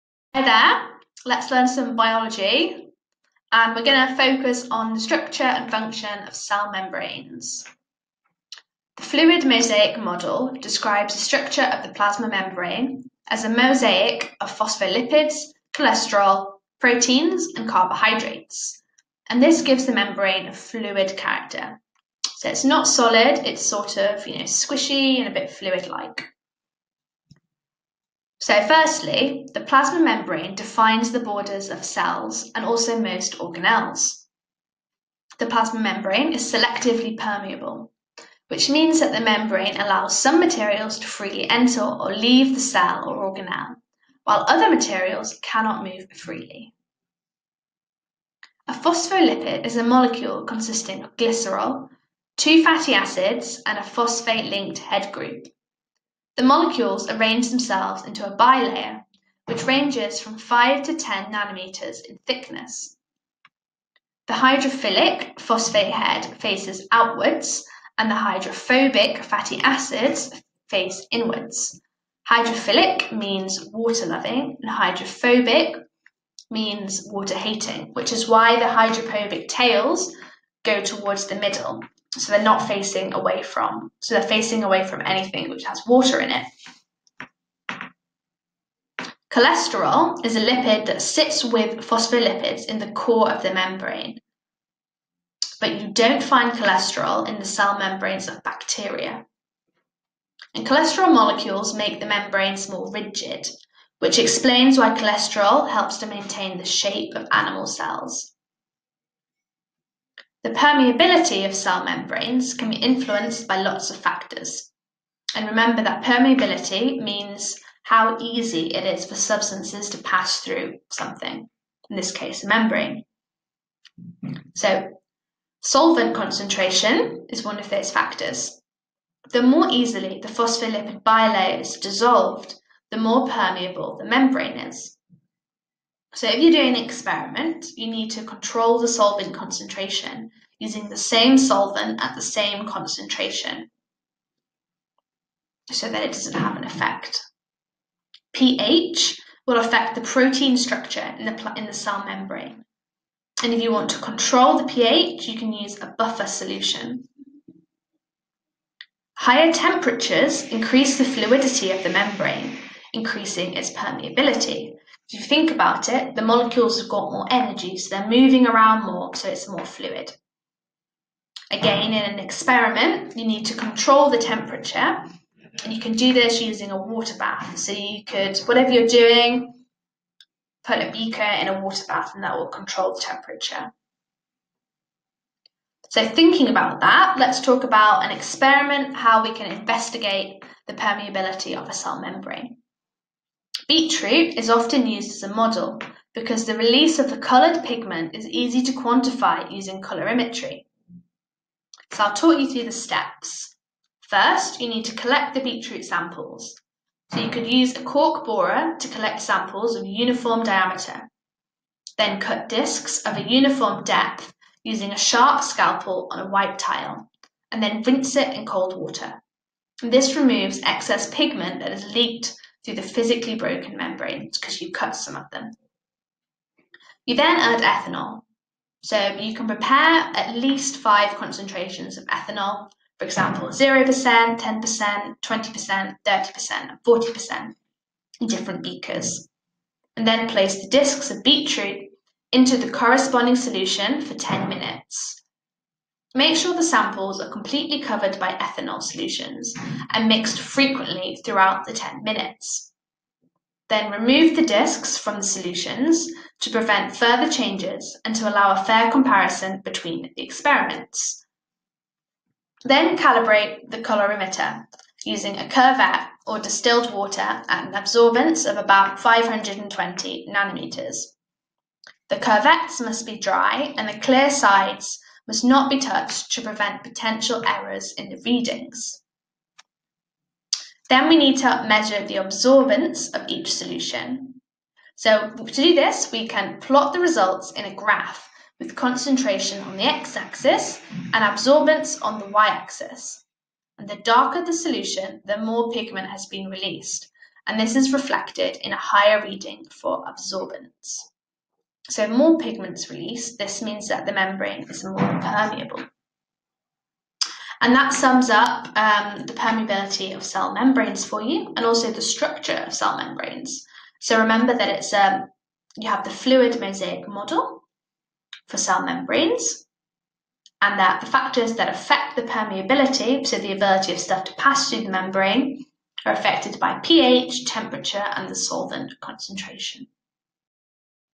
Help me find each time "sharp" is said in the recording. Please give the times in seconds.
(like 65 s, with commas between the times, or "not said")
214 s.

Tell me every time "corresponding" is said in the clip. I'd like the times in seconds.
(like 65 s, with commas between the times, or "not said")
242 s.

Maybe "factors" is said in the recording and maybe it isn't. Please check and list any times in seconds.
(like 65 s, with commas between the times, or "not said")
113 s, 127 s, 321 s.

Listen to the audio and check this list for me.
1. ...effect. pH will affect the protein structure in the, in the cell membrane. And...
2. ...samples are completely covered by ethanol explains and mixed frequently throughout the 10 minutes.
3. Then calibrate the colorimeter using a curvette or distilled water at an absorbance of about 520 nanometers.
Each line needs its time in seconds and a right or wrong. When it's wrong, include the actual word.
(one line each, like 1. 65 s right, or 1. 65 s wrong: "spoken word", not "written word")
1. 146 s right
2. 246 s wrong: "solutions", not "explains"
3. 262 s right.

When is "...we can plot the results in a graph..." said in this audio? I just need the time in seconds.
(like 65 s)
286 s.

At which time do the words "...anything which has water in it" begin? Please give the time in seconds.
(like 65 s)
85 s.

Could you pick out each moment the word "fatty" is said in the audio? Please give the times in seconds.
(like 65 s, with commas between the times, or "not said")
52 s, 69 s.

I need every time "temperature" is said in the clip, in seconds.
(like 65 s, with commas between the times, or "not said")
159 s, 174 s, 183 s, 327 s.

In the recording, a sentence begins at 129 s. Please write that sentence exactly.
The more easily the phospholipid bilayer is dissolved, the more permeable the membrane is.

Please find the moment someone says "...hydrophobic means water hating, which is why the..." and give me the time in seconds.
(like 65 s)
74 s.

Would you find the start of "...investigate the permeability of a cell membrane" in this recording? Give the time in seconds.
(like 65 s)
189 s.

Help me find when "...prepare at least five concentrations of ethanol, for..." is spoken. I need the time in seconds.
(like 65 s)
229 s.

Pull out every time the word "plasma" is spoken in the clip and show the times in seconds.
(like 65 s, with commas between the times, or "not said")
11 s, 29 s, 35 s.